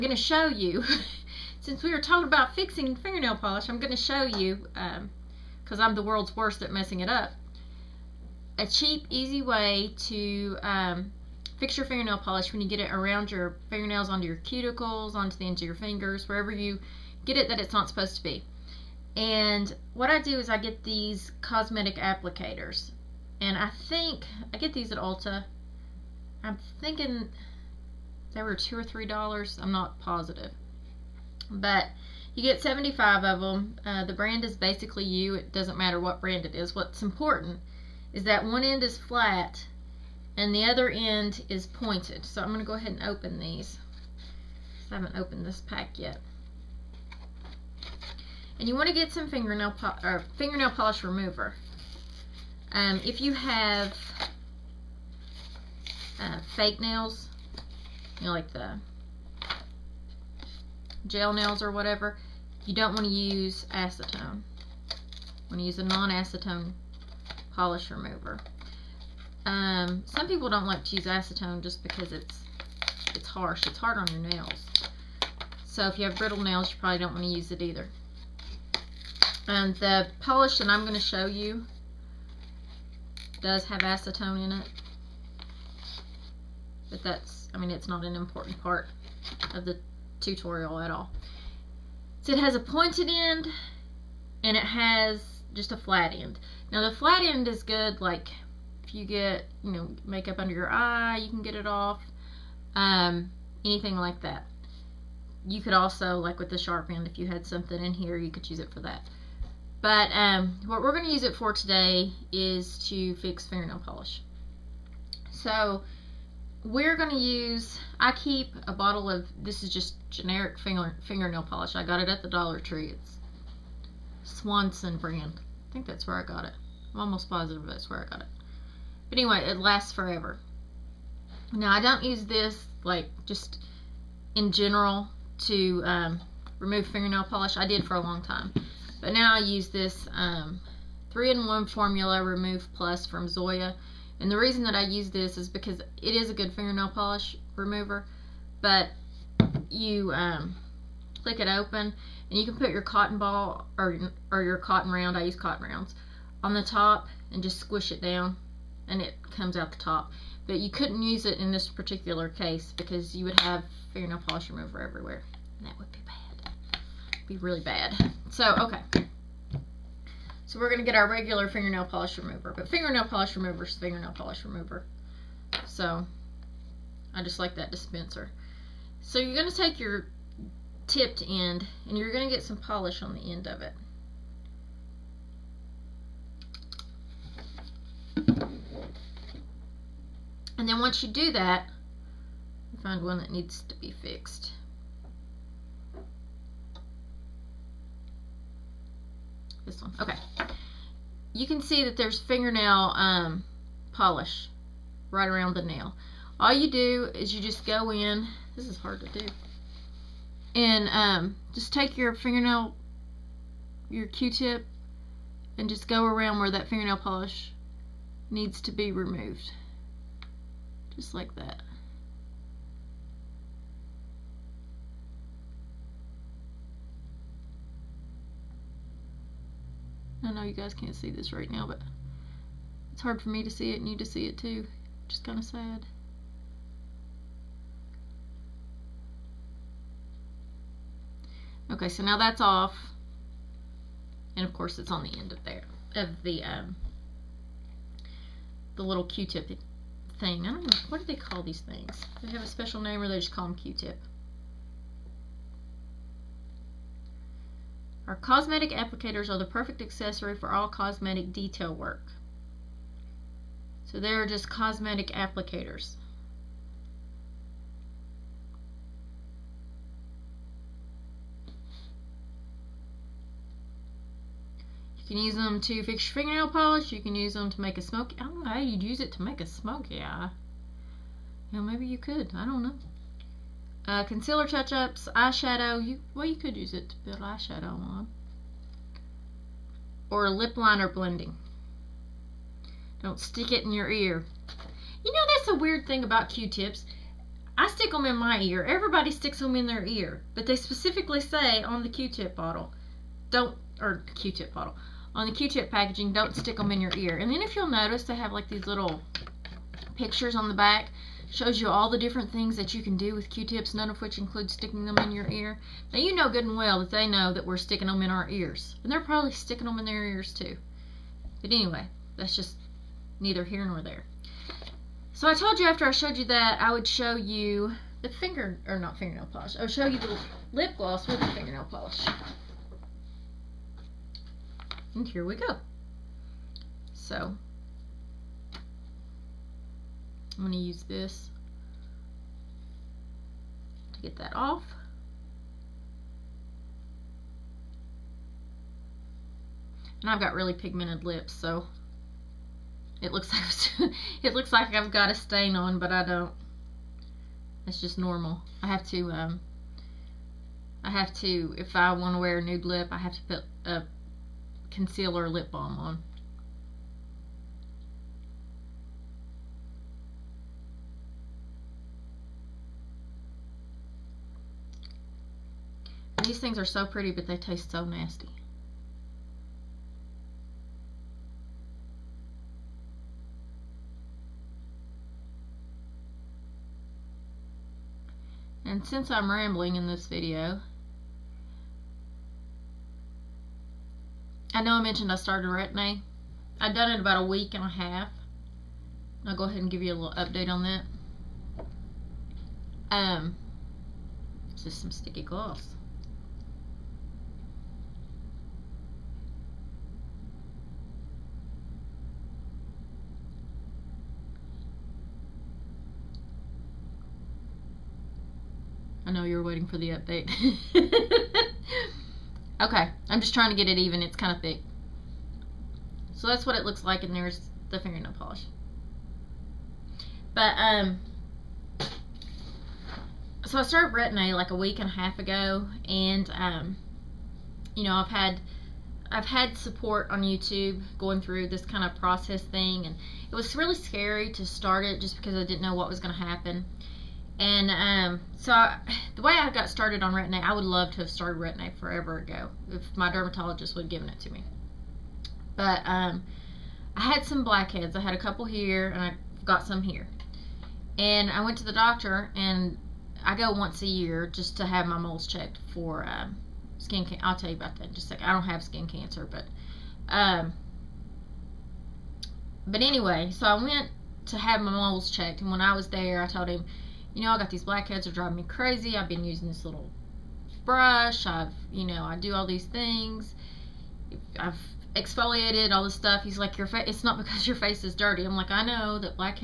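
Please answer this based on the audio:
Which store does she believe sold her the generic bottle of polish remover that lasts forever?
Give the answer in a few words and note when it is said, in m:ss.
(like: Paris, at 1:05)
Dollar Tree, at 2:02.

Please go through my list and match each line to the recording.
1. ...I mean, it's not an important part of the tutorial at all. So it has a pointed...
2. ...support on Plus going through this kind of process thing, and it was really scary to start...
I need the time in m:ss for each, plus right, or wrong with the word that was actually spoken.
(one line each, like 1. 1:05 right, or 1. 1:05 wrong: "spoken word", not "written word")
1. 1:27 right
2. 7:19 wrong: "YouTube", not "Plus".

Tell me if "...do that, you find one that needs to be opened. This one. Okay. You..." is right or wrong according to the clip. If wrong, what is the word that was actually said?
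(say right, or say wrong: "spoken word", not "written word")
wrong: "fixed", not "opened".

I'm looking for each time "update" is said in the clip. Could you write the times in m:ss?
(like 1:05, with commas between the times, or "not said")
6:40, 6:59.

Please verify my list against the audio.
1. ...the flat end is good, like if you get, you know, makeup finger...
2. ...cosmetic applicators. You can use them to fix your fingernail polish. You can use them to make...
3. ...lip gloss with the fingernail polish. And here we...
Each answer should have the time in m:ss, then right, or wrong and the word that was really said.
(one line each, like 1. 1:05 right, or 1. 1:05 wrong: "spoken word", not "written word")
1. 1:36 wrong: "under", not "finger"
2. 4:24 right
3. 5:30 right.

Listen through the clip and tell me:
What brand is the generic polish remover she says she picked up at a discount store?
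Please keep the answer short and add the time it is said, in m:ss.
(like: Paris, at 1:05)
Swanson, at 2:04.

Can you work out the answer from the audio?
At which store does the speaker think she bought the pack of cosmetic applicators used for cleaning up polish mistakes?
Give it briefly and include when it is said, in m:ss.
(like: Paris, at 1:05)
Ulta, at 0:24.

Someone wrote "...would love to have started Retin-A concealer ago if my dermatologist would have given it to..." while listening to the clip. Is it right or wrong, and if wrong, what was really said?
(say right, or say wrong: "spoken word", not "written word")
wrong: "forever", not "concealer".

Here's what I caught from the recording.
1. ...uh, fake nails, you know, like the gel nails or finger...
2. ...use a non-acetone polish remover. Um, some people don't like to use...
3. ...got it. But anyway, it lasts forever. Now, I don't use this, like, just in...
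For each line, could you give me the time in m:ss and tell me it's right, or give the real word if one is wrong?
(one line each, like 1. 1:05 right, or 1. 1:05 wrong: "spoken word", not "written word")
1. 0:56 wrong: "whatever", not "finger"
2. 1:05 right
3. 2:08 right.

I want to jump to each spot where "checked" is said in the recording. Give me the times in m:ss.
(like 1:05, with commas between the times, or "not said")
7:45, 7:55.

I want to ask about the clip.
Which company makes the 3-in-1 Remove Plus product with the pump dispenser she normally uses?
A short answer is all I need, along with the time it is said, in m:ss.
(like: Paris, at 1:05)
Zoya, at 2:23.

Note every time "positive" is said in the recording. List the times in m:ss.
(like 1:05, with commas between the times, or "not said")
0:29, 2:07.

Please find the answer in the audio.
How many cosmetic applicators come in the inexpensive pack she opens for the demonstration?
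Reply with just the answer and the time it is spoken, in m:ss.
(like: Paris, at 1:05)
75, at 0:32.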